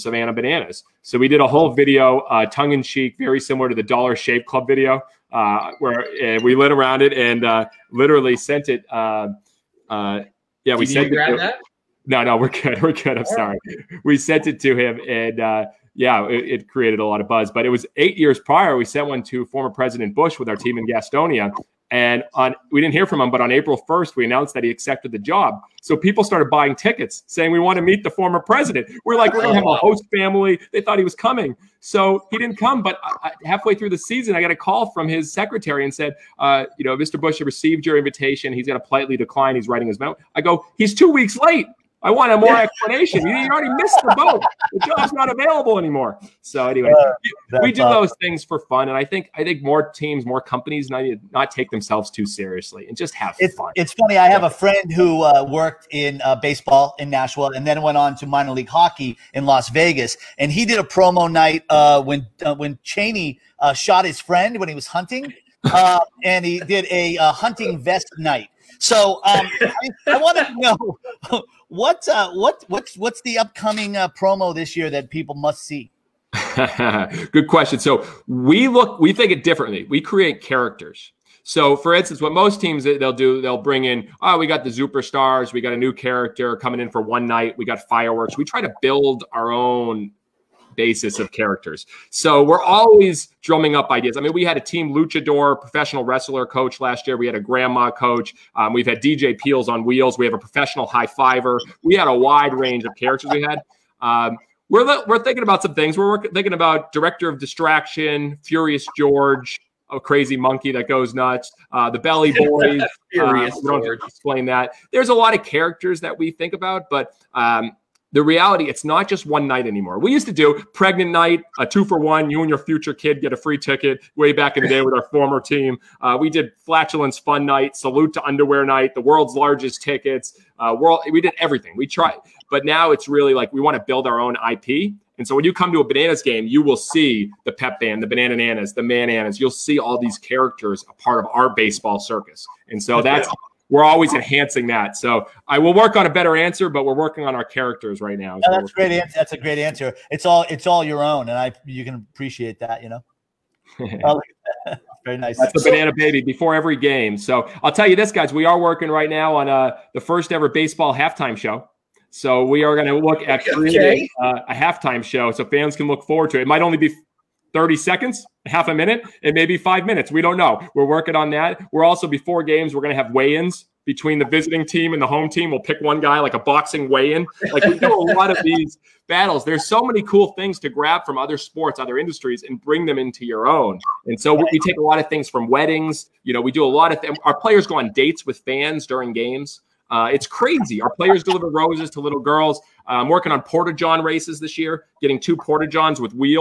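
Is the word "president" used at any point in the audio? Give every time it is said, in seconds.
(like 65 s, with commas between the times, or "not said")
19 s, 28 s.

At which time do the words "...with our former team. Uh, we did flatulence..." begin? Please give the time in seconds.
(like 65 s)
124 s.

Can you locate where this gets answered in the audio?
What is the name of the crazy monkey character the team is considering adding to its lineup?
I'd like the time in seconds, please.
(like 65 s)
108 s.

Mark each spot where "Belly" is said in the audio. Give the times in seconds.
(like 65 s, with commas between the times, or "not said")
111 s.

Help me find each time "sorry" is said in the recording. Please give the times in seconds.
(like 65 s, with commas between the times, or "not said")
13 s.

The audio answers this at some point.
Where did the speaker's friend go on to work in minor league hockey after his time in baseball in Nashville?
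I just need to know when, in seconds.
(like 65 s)
59 s.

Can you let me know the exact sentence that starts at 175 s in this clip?
We'll pick one guy like a boxing weigh-in.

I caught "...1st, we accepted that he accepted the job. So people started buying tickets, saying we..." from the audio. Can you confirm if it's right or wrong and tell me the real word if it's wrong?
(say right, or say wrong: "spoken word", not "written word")
wrong: "announced", not "accepted".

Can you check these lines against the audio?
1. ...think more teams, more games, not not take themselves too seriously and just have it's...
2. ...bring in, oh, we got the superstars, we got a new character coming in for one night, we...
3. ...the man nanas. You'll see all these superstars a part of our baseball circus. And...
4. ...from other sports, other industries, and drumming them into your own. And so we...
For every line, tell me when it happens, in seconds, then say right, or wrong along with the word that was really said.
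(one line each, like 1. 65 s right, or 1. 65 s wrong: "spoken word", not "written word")
1. 49 s wrong: "companies", not "games"
2. 83 s right
3. 138 s wrong: "characters", not "superstars"
4. 181 s wrong: "bring", not "drumming".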